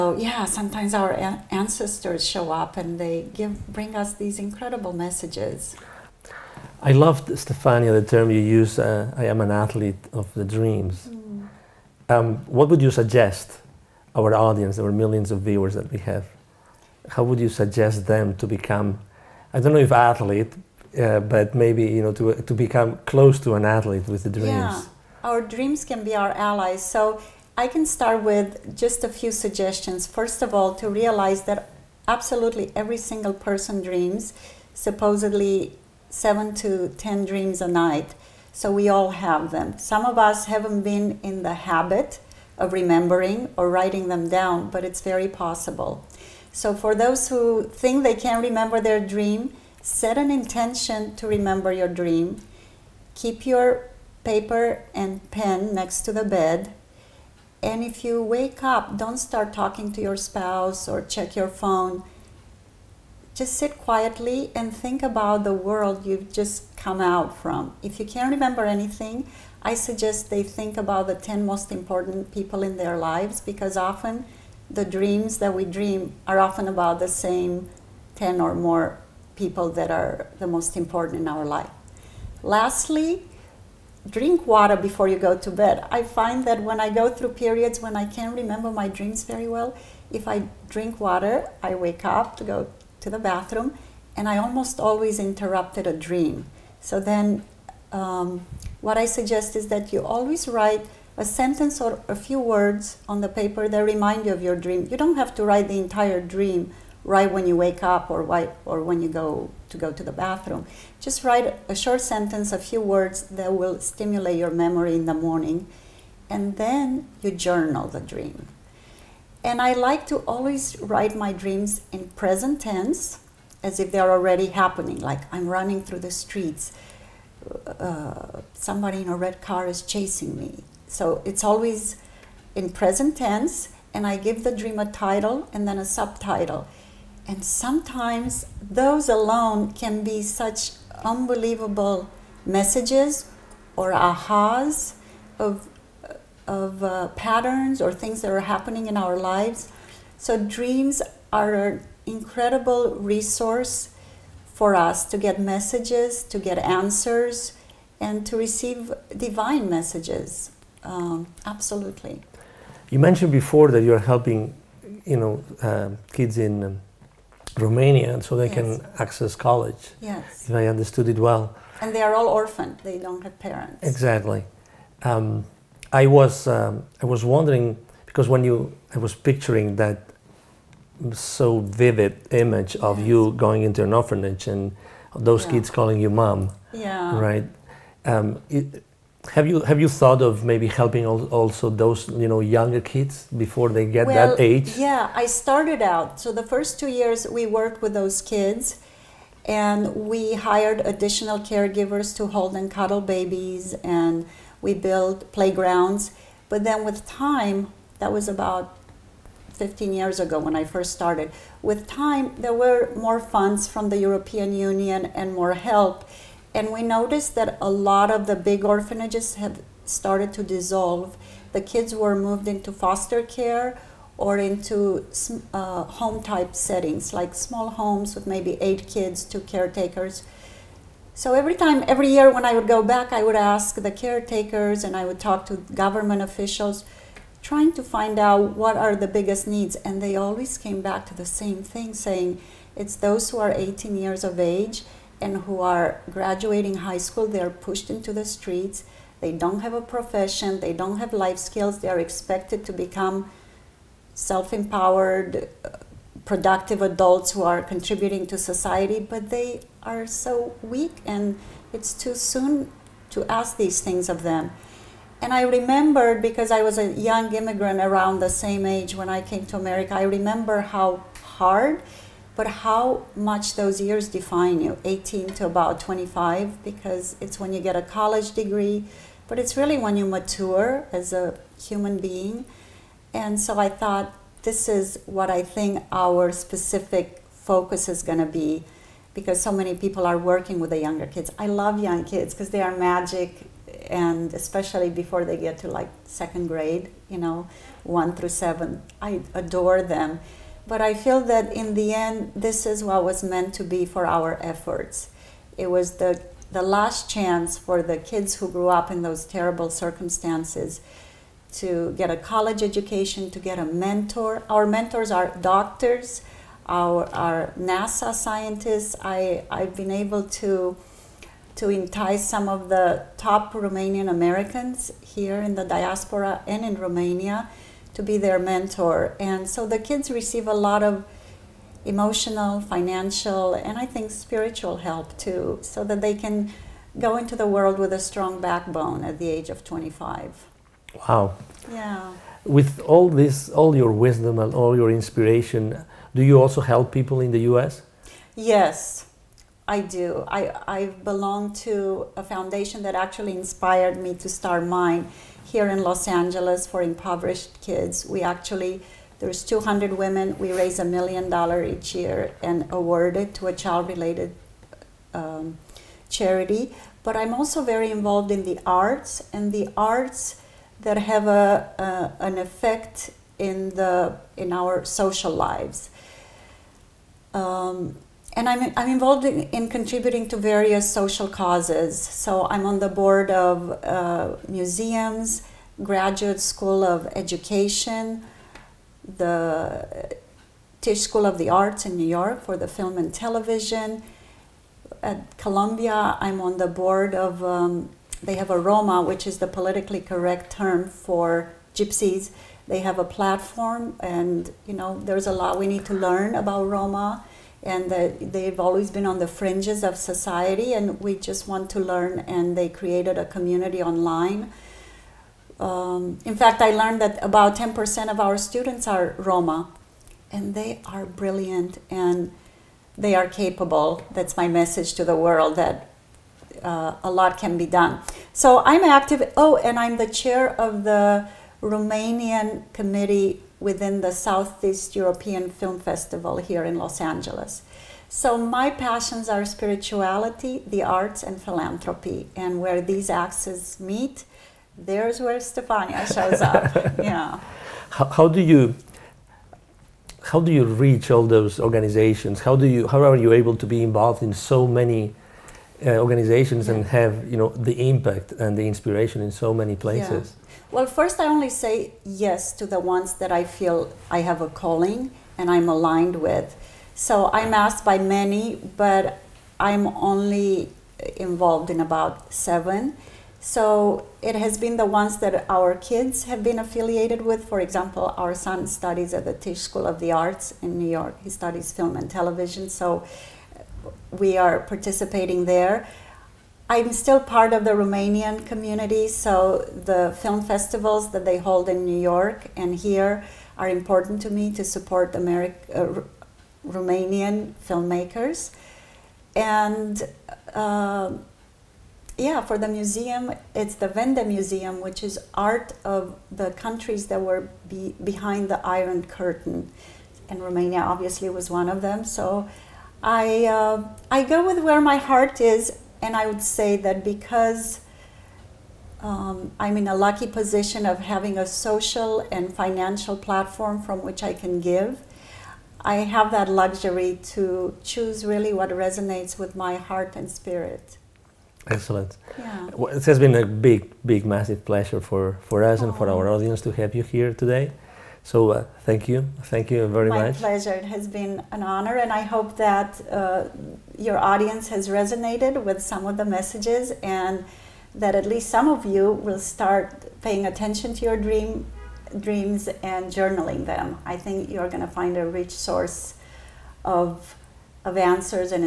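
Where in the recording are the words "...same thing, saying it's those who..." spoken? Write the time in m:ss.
4:01.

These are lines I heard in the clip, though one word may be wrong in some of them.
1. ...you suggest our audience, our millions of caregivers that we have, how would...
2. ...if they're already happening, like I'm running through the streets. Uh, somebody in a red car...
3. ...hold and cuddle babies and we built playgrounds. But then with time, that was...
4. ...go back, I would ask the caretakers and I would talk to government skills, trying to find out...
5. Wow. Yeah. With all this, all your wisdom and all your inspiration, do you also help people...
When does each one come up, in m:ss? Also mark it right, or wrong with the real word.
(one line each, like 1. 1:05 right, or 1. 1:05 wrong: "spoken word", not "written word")
1. 0:12 wrong: "viewers", not "caregivers"
2. 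2:03 right
3. 3:22 right
4. 3:52 wrong: "officials", not "skills"
5. 5:41 right.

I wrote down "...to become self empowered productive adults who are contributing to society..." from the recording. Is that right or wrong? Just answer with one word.
right.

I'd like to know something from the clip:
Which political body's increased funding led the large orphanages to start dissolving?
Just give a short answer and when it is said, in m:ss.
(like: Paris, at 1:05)
European Union, at 3:33.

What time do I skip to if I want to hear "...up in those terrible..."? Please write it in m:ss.
5:08.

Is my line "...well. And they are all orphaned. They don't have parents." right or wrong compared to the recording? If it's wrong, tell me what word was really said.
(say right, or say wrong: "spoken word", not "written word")
right.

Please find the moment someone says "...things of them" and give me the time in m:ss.
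4:23.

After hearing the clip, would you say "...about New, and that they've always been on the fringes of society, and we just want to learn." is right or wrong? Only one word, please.
wrong.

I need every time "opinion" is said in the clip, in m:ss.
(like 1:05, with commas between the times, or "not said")
not said.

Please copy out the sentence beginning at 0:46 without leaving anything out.
So for those who think they can not remember their dream, set an intention to remember your dream.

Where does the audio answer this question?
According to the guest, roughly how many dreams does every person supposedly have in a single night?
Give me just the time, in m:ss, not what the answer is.
0:36.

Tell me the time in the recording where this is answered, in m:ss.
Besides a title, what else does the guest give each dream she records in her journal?
2:15.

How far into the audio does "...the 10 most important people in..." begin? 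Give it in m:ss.
1:11.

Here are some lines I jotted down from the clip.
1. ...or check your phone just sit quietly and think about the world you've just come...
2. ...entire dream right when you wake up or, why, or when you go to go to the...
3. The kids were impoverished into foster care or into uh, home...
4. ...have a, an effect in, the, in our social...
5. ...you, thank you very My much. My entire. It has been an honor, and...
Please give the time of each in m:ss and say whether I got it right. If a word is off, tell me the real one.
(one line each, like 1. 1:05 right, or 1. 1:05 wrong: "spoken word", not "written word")
1. 1:00 right
2. 1:45 right
3. 3:41 wrong: "moved", not "impoverished"
4. 6:10 right
5. 8:59 wrong: "pleasure", not "entire".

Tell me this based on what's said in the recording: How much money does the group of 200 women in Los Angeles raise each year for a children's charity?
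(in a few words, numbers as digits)
A million dollars.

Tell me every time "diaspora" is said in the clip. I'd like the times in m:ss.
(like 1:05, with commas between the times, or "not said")
5:25.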